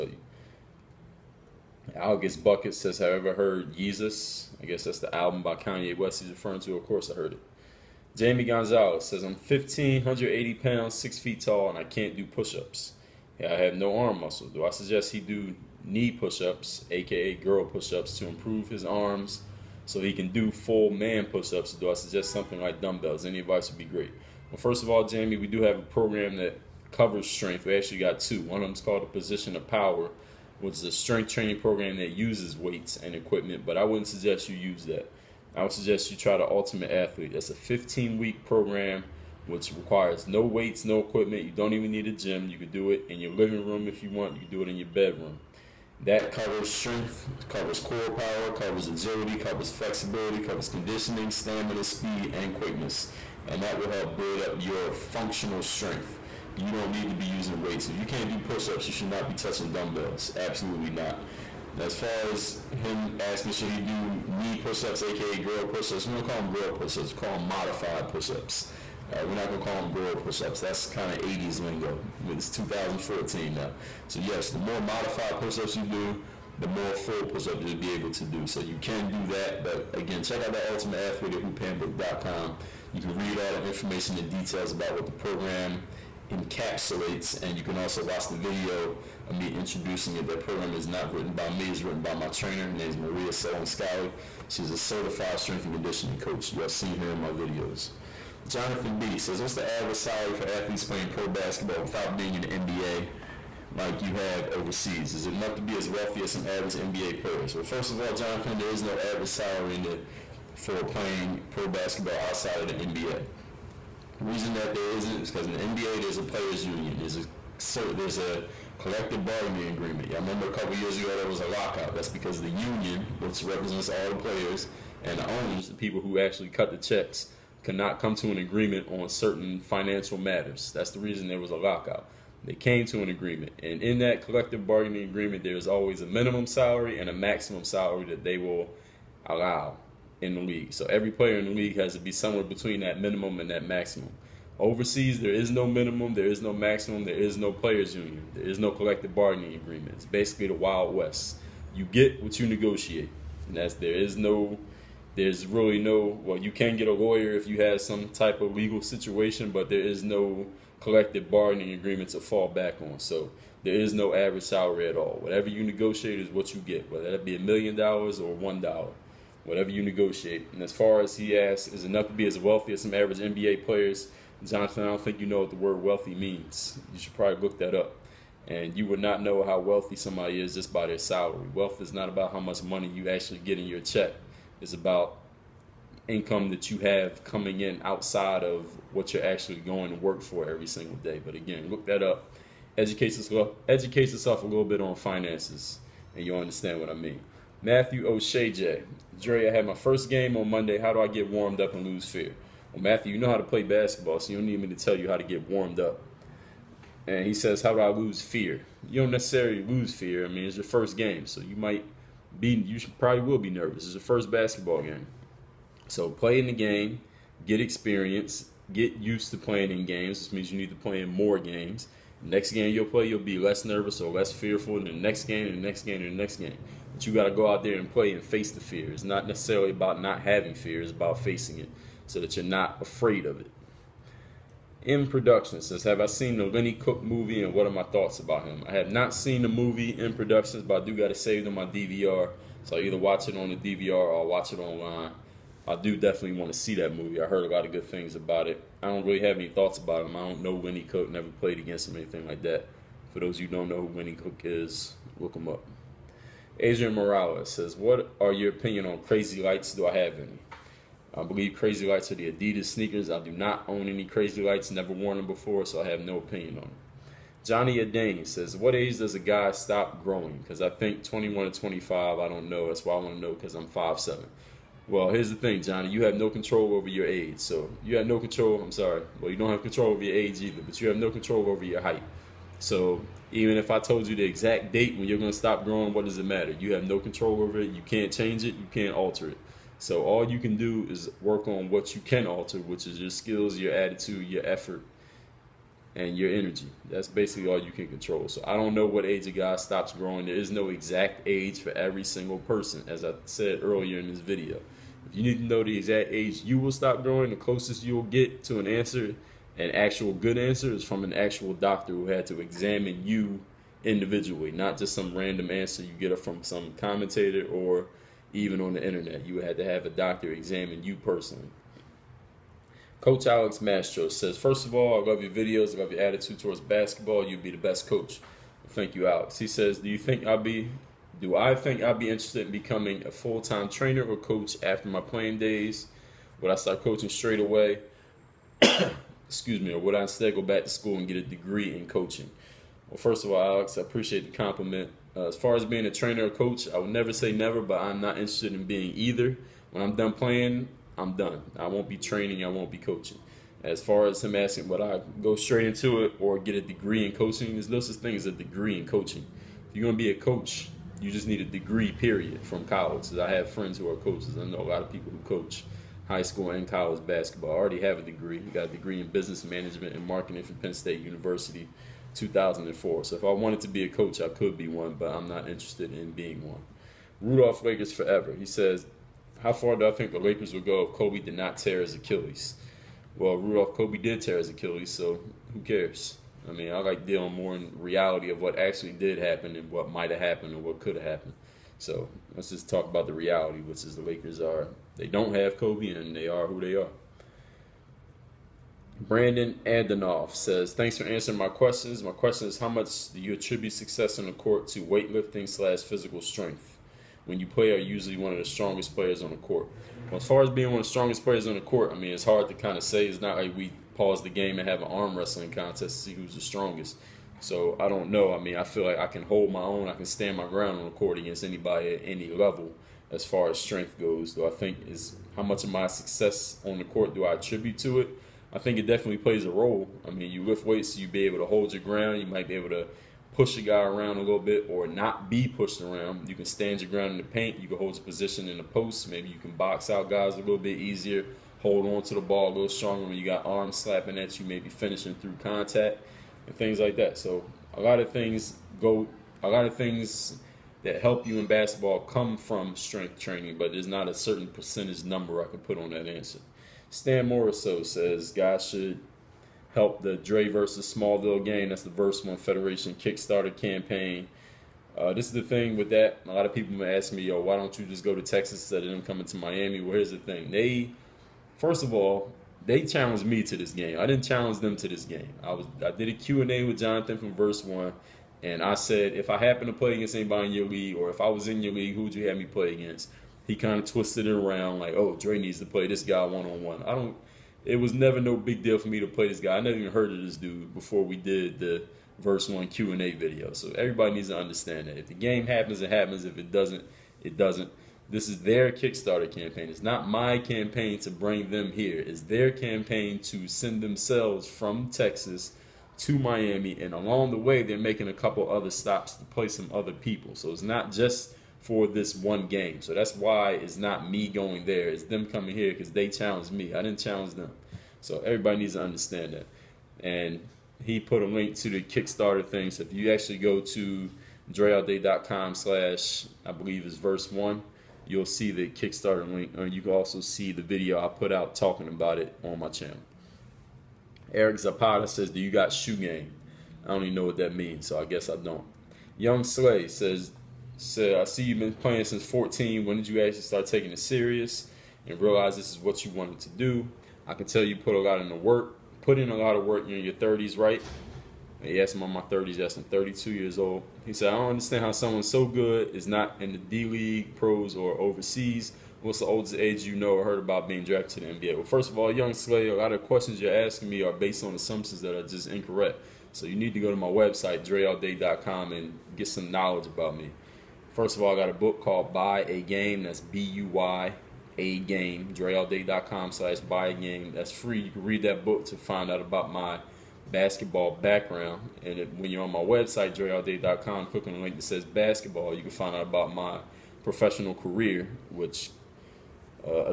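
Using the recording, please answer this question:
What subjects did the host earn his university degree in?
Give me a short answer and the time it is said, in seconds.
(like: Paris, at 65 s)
Business management and marketing, at 369 s.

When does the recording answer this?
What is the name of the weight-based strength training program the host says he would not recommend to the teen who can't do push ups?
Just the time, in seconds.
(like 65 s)
29 s.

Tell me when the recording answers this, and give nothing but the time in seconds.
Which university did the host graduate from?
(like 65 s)
370 s.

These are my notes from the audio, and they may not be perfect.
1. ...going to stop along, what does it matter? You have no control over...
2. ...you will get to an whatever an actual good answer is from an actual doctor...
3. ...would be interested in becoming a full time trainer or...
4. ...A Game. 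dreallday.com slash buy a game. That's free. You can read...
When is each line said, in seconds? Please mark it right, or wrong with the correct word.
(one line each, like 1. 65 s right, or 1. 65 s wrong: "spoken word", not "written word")
1. 285 s wrong: "growing", not "along"
2. 307 s wrong: "answer", not "whatever"
3. 331 s right
4. 574 s right.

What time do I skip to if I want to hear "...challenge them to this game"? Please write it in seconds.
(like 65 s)
474 s.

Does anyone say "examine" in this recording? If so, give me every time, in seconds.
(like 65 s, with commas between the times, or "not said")
312 s, 320 s.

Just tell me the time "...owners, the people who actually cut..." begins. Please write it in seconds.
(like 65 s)
125 s.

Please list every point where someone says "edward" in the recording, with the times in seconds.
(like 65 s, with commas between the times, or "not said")
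not said.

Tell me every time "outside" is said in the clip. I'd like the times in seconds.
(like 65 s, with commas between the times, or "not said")
112 s, 187 s.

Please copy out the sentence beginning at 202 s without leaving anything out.
Well, Matthew, you know how to play basketball, so you don't need me to tell you how to get warmed up.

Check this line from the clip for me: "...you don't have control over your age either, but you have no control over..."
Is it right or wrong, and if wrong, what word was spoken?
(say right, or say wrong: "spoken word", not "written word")
right.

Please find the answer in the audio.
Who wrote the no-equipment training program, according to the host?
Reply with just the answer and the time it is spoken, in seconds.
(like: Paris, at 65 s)
Maria Solon, at 92 s.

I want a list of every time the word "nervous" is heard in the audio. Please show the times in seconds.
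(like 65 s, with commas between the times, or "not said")
213 s, 223 s.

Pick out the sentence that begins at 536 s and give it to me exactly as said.
I don't even know what that means, so I guess I don't.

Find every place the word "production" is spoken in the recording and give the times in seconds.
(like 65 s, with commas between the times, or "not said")
235 s, 240 s.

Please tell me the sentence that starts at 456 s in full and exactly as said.
Stan Moriso says guys should help the Dre versus Smallville game.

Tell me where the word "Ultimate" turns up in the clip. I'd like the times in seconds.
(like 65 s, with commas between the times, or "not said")
36 s, 80 s.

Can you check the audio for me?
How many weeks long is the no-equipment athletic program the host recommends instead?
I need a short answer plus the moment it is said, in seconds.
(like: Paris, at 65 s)
15, at 37 s.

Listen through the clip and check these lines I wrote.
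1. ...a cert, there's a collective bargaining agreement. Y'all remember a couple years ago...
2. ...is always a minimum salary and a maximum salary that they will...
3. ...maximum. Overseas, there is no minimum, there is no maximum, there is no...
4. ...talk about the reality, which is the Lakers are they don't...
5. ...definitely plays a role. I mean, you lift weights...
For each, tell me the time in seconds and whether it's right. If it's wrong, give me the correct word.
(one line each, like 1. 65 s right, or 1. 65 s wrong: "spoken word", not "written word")
1. 117 s right
2. 135 s right
3. 143 s right
4. 392 s right
5. 428 s right.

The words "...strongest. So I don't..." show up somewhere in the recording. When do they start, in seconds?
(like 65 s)
416 s.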